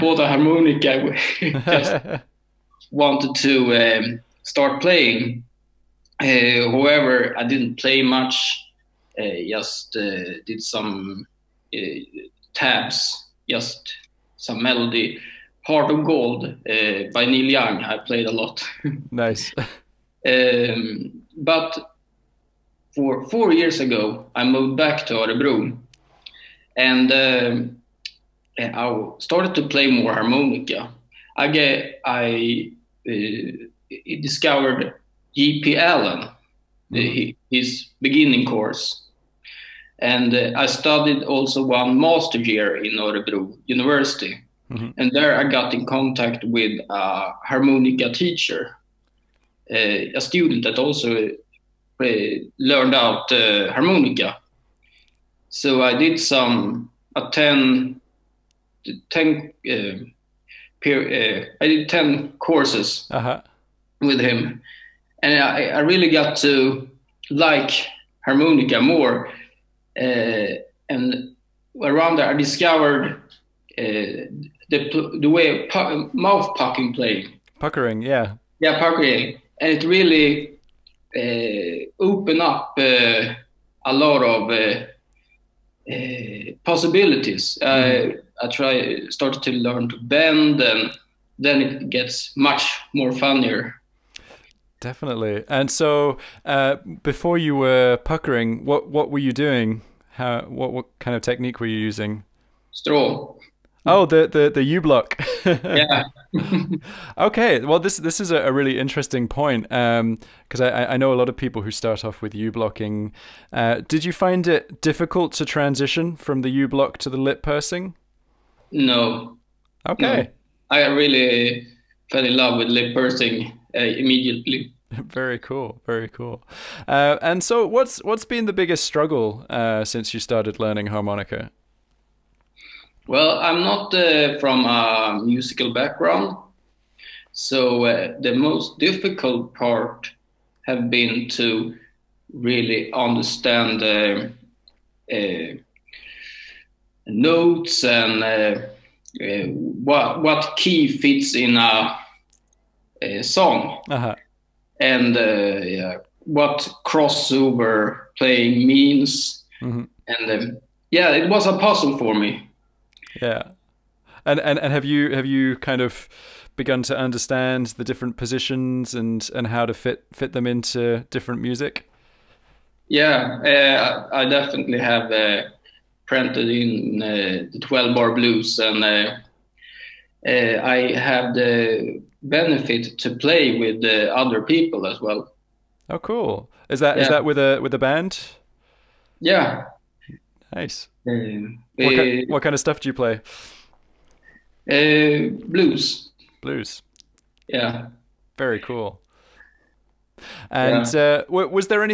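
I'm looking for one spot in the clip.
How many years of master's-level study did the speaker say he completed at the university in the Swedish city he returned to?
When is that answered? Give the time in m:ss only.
0:41.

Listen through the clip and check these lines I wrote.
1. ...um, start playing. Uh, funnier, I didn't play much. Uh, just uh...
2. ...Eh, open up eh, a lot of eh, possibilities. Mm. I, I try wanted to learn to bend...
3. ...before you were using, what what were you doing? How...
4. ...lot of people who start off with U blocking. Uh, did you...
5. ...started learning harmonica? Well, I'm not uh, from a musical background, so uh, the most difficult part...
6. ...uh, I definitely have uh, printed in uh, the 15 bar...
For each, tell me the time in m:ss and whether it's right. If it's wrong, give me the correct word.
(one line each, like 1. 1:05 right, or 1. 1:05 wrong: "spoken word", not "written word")
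1. 0:03 wrong: "however", not "funnier"
2. 1:21 wrong: "started", not "wanted"
3. 1:37 wrong: "puckering", not "using"
4. 1:51 right
5. 2:10 right
6. 2:53 wrong: "12", not "15".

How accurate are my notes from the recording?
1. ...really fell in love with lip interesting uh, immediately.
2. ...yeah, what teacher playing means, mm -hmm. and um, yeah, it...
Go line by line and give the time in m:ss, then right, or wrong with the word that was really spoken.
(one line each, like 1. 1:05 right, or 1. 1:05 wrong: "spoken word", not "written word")
1. 2:00 wrong: "pursing", not "interesting"
2. 2:35 wrong: "crossover", not "teacher".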